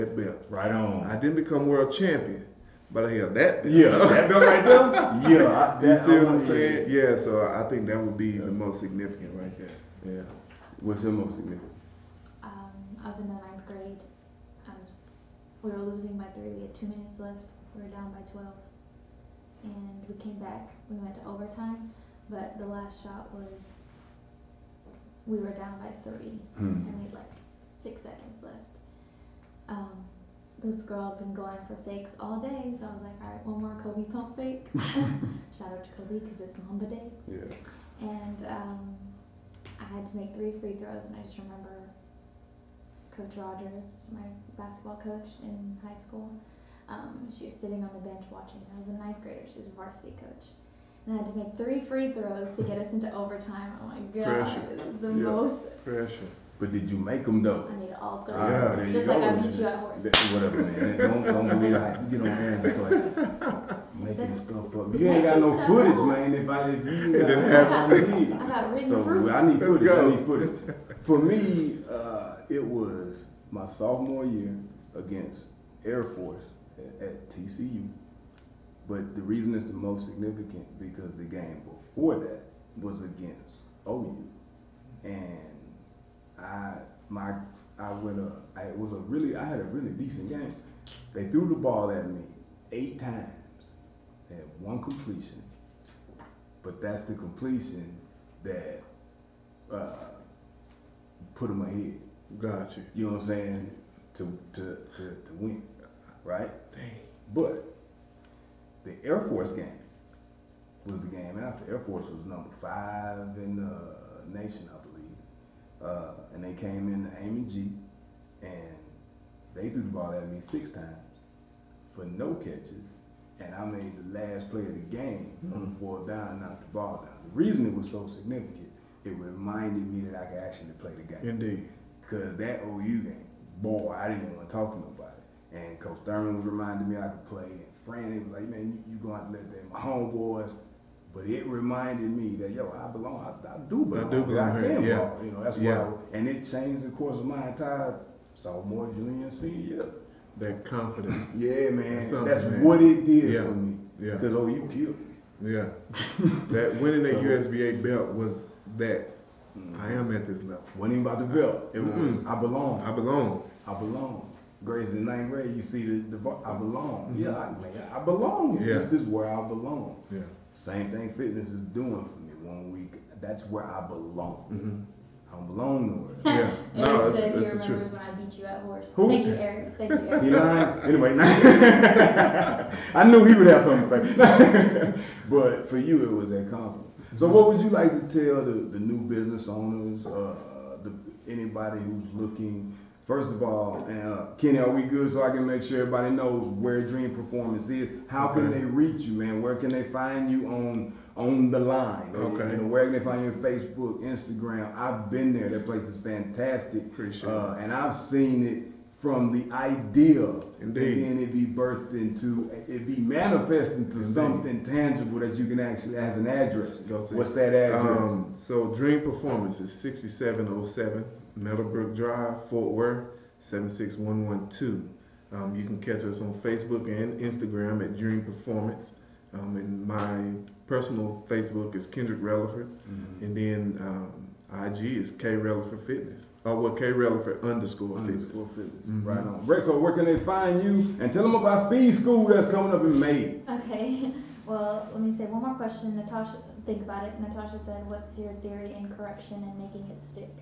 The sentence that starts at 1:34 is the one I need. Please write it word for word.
They had one completion, but that's the completion that uh, put them ahead.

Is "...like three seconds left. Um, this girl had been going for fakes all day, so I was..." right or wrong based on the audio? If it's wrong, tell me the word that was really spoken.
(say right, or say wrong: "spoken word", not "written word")
wrong: "six", not "three".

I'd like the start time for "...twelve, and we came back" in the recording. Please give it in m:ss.
0:18.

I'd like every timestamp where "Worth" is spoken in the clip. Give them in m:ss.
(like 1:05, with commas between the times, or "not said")
3:42.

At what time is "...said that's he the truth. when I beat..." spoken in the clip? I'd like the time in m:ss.
2:57.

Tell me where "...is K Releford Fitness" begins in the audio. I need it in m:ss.
3:54.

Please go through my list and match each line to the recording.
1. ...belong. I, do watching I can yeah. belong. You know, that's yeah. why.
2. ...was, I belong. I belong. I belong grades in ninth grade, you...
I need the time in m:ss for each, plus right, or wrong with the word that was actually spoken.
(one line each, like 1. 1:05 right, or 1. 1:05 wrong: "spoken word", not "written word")
1. 2:23 wrong: "belong", not "watching"
2. 2:41 right.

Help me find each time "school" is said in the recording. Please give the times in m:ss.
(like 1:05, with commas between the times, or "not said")
0:46, 4:01.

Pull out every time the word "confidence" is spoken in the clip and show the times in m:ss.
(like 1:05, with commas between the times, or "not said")
2:30, 3:06.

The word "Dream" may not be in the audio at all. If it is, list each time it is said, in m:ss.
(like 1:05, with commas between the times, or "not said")
3:16, 3:38, 3:47.